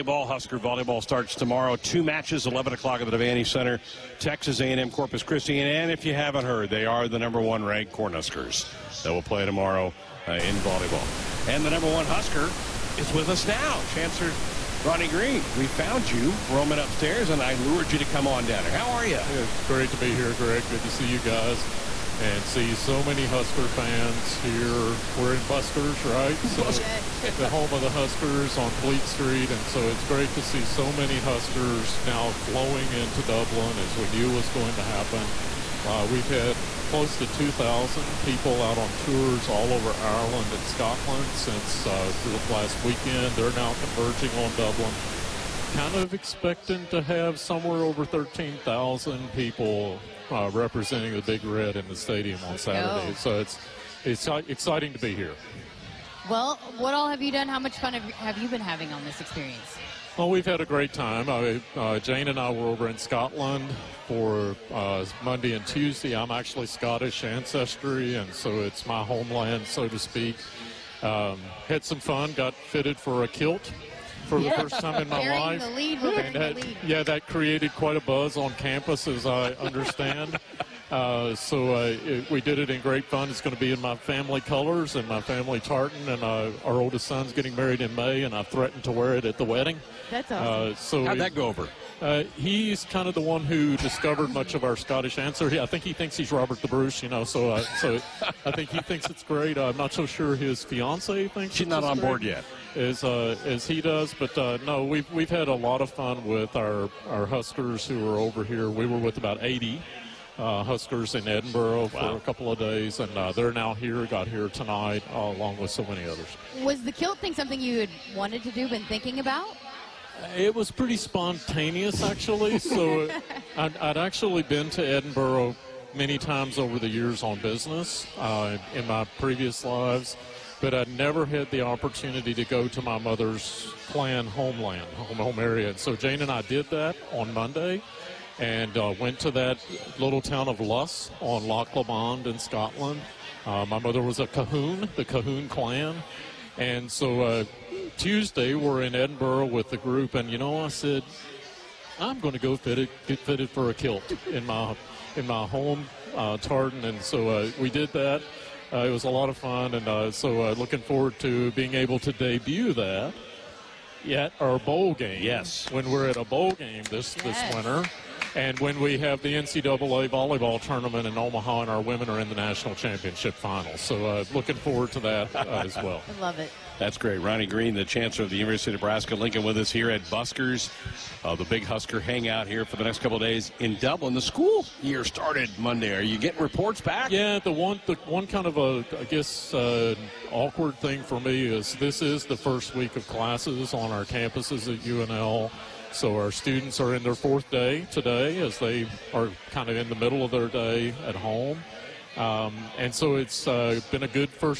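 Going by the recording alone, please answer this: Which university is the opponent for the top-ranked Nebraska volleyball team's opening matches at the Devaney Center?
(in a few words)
Texas A&M Corpus Christi.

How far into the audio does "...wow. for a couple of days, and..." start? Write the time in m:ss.
1:51.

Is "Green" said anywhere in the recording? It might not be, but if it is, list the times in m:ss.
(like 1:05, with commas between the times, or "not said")
0:15, 2:57.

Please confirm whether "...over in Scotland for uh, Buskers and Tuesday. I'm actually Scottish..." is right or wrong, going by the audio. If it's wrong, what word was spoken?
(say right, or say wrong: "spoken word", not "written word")
wrong: "Monday", not "Buskers".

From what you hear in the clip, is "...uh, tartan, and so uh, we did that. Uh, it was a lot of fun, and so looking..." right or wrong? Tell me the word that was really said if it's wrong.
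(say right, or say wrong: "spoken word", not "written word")
right.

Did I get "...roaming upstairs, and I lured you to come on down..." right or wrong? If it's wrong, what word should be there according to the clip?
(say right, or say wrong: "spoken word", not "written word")
right.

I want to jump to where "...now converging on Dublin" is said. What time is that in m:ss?
0:43.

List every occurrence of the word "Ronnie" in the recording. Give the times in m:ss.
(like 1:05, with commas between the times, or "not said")
0:14, 2:57.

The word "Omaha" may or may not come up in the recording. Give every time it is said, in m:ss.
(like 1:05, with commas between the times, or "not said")
2:51.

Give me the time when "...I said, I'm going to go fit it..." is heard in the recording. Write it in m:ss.
2:30.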